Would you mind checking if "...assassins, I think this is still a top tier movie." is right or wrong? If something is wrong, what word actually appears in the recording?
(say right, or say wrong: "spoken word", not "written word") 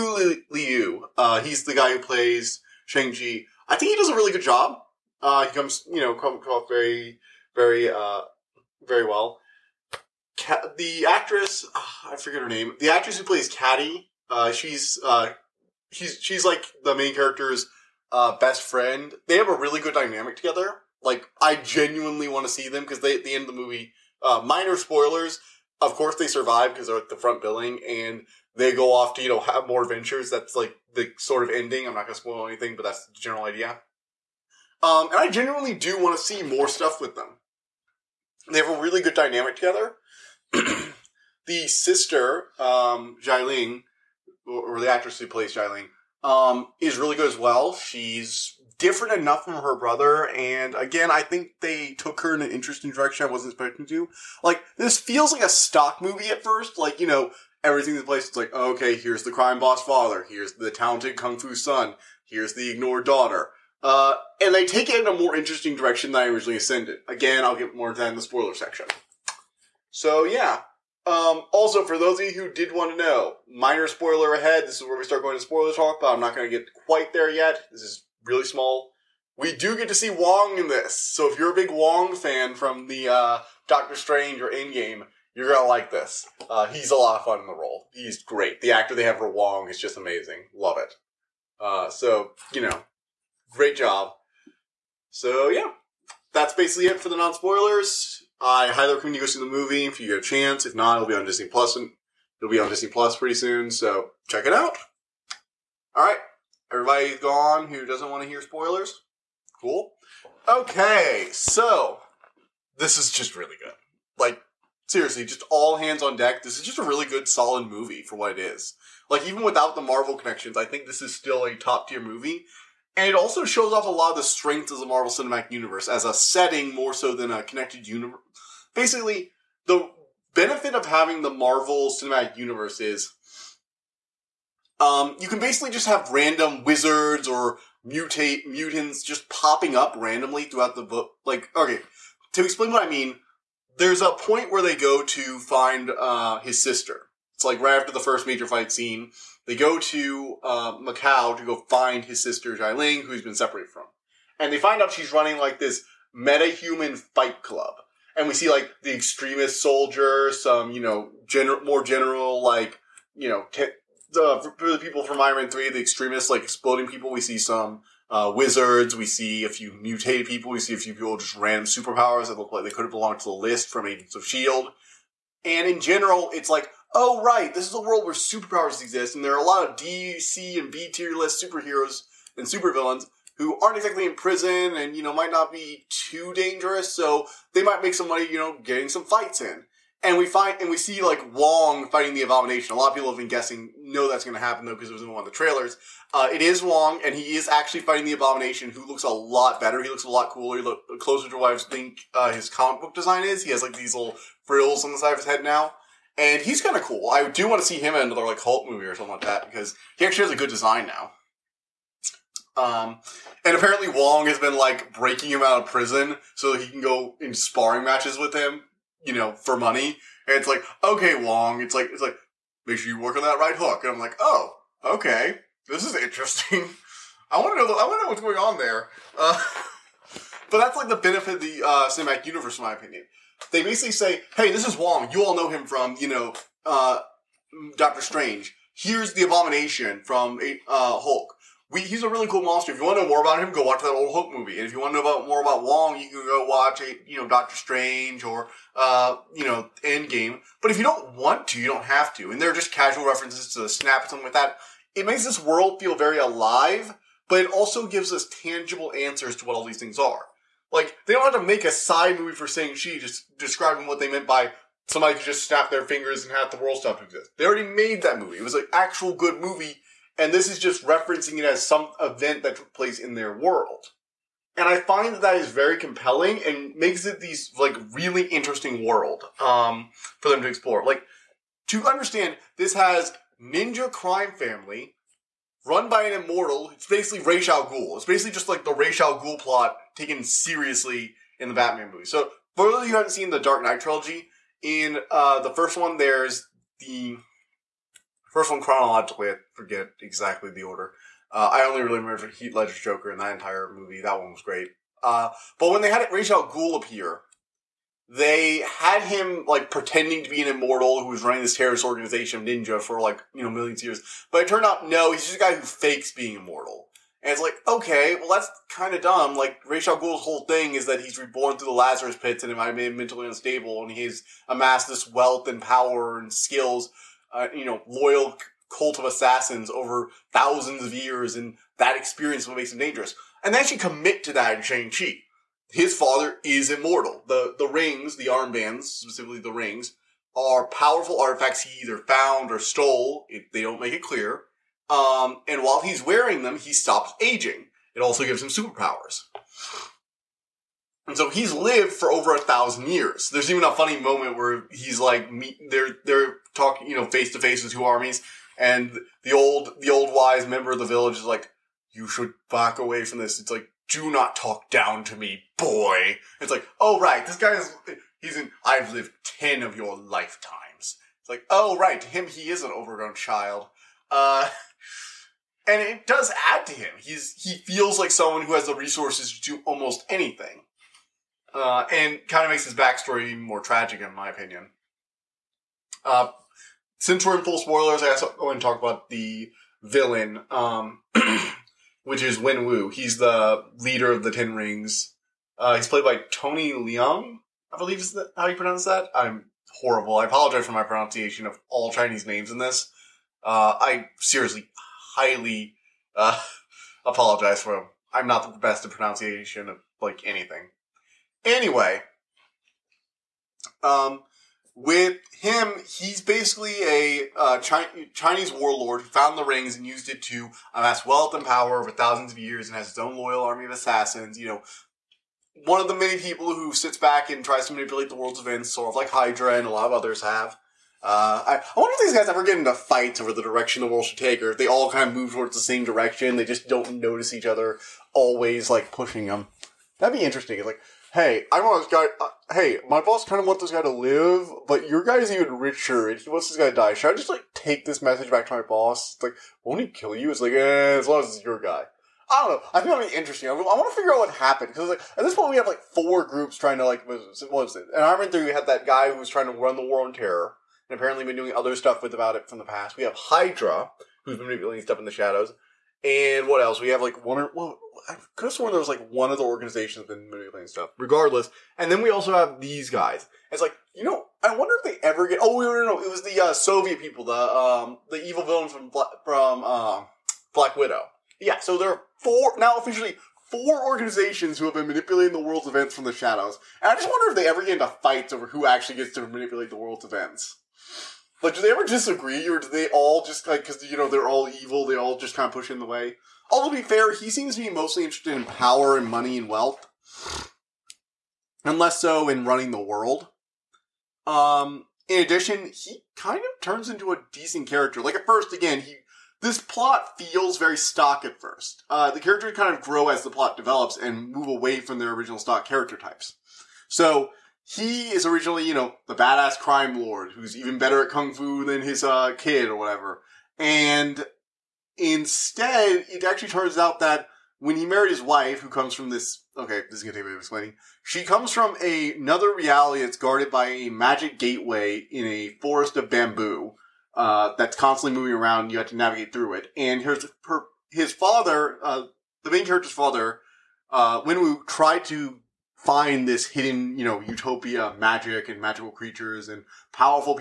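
wrong: "connections", not "assassins".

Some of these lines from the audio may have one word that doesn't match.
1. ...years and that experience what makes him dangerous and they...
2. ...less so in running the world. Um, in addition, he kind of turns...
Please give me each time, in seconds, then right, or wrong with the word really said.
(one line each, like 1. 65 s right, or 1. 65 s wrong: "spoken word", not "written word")
1. 330 s right
2. 501 s right.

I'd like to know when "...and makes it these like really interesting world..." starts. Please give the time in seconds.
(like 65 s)
276 s.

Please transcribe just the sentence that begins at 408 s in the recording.
I'm not the best at pronunciation of like anything.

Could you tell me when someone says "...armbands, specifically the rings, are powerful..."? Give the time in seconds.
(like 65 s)
338 s.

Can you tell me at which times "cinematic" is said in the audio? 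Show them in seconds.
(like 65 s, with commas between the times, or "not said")
125 s, 131 s, 231 s.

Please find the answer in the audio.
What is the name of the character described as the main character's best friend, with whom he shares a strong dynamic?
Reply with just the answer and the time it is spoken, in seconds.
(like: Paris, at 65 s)
Katie, at 13 s.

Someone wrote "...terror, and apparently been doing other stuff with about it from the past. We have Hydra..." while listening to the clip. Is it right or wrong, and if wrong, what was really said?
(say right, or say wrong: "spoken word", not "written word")
right.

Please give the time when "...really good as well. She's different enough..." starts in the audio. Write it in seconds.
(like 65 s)
46 s.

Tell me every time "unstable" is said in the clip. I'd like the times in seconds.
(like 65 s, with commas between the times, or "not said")
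323 s.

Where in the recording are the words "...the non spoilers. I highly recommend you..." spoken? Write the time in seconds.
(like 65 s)
97 s.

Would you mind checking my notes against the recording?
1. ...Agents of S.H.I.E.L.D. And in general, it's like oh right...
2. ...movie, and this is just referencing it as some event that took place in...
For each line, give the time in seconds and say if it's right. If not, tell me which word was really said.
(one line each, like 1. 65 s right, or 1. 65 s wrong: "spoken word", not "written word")
1. 173 s right
2. 269 s right.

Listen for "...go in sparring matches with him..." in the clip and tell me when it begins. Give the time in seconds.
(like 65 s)
216 s.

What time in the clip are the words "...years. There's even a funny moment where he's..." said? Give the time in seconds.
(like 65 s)
352 s.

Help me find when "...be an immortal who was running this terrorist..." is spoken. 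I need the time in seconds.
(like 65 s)
310 s.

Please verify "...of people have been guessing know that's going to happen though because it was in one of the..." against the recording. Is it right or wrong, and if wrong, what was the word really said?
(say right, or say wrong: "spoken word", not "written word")
right.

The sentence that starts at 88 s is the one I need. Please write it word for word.
The actor they have for Wong is just amazing.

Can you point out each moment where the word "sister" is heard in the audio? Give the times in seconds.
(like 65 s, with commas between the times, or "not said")
41 s, 146 s, 152 s.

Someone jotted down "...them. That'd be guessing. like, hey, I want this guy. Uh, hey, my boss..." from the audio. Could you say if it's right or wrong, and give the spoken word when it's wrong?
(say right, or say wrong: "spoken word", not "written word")
wrong: "interesting", not "guessing".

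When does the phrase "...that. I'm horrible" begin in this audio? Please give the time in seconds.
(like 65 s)
398 s.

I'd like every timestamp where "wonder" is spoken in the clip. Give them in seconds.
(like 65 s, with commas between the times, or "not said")
431 s, 474 s, 487 s.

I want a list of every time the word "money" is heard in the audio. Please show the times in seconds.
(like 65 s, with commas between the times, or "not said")
188 s, 219 s, 499 s.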